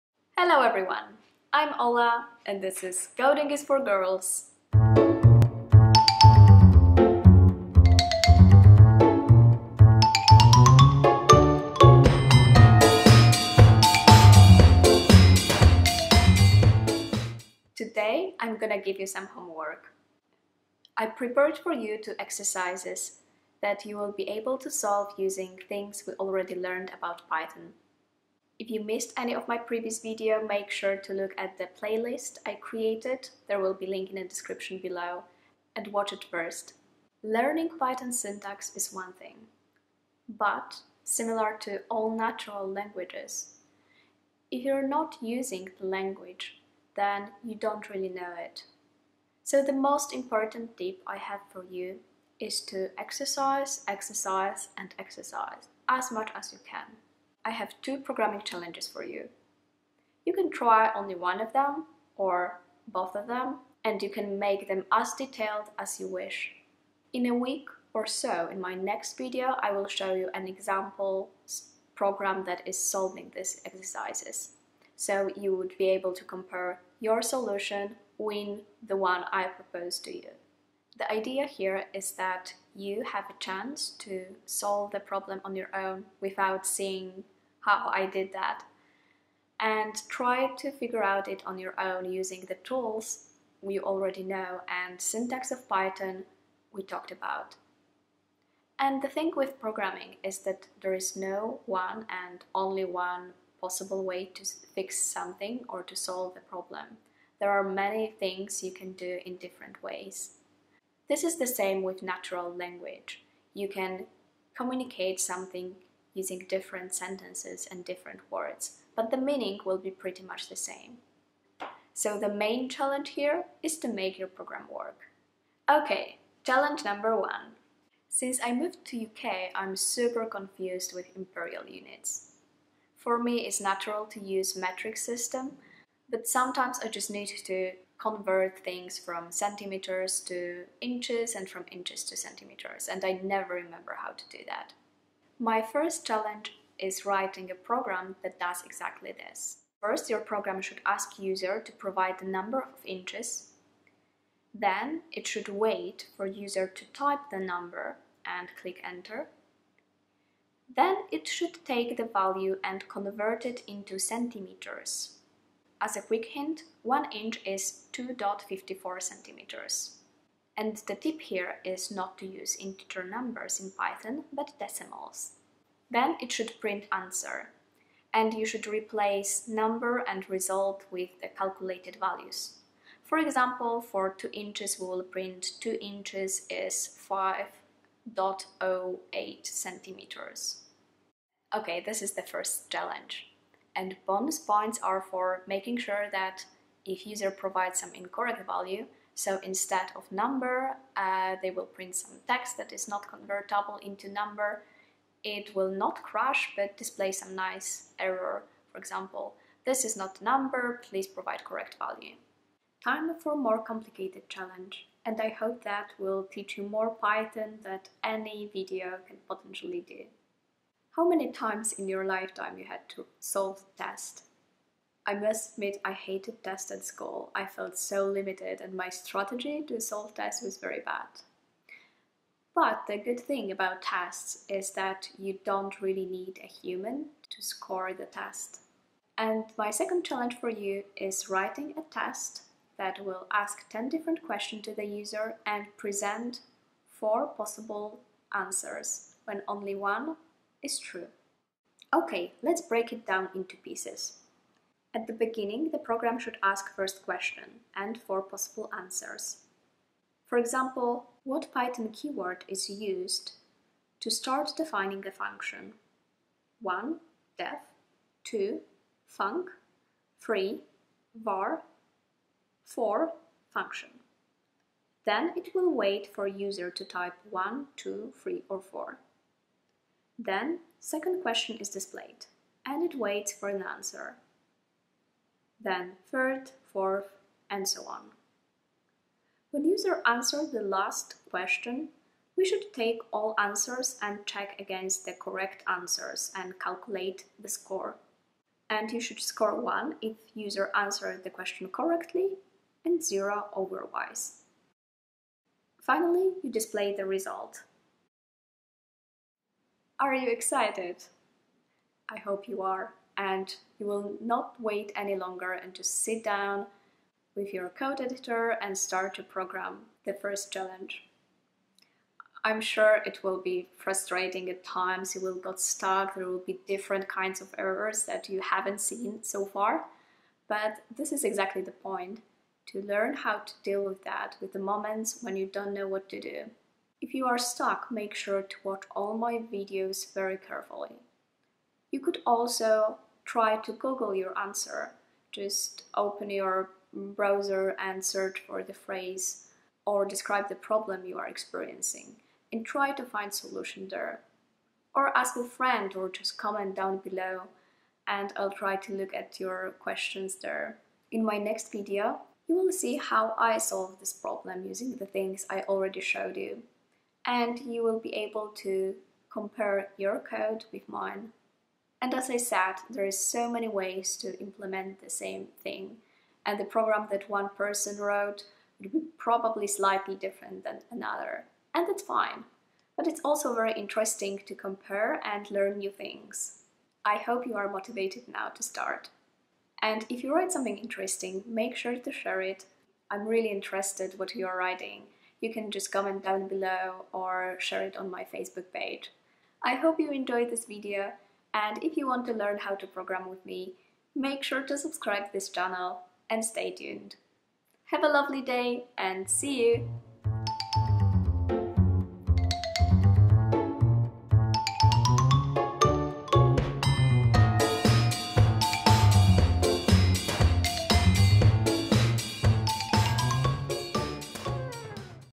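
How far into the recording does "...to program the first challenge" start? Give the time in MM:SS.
05:19.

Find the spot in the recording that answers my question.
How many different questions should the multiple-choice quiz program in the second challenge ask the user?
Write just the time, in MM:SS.
04:03.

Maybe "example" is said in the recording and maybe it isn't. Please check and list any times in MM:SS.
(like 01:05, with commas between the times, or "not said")
01:10, 03:03, 03:28, 04:20.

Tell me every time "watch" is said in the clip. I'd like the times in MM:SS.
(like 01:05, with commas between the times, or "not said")
00:35, 05:38.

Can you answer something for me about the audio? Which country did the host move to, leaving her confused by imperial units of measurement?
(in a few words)
UK.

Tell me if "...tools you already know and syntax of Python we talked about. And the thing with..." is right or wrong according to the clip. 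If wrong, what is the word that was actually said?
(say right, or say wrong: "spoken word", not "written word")
right.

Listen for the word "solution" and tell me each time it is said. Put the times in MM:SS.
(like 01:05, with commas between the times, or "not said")
01:17, 05:53.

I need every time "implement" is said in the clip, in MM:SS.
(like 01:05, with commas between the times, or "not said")
06:14.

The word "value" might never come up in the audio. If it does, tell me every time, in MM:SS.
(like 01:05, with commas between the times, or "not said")
02:42, 03:01, 03:18, 03:31.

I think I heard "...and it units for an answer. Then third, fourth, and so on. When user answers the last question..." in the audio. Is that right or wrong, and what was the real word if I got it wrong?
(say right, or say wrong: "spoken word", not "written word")
wrong: "waits", not "units".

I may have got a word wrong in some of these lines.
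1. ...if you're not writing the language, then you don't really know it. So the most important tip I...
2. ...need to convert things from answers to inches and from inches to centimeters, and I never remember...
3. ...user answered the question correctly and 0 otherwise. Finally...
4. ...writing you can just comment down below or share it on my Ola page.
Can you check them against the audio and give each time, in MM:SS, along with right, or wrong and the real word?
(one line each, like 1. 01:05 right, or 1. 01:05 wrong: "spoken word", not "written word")
1. 00:44 wrong: "using", not "writing"
2. 02:17 wrong: "centimeters", not "answers"
3. 05:00 right
4. 06:34 wrong: "Facebook", not "Ola".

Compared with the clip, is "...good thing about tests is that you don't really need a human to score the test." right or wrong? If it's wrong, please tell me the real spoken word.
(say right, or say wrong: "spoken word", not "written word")
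right.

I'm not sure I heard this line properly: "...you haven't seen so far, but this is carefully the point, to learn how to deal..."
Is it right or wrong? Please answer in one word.
wrong.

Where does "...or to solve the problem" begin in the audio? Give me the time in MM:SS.
01:45.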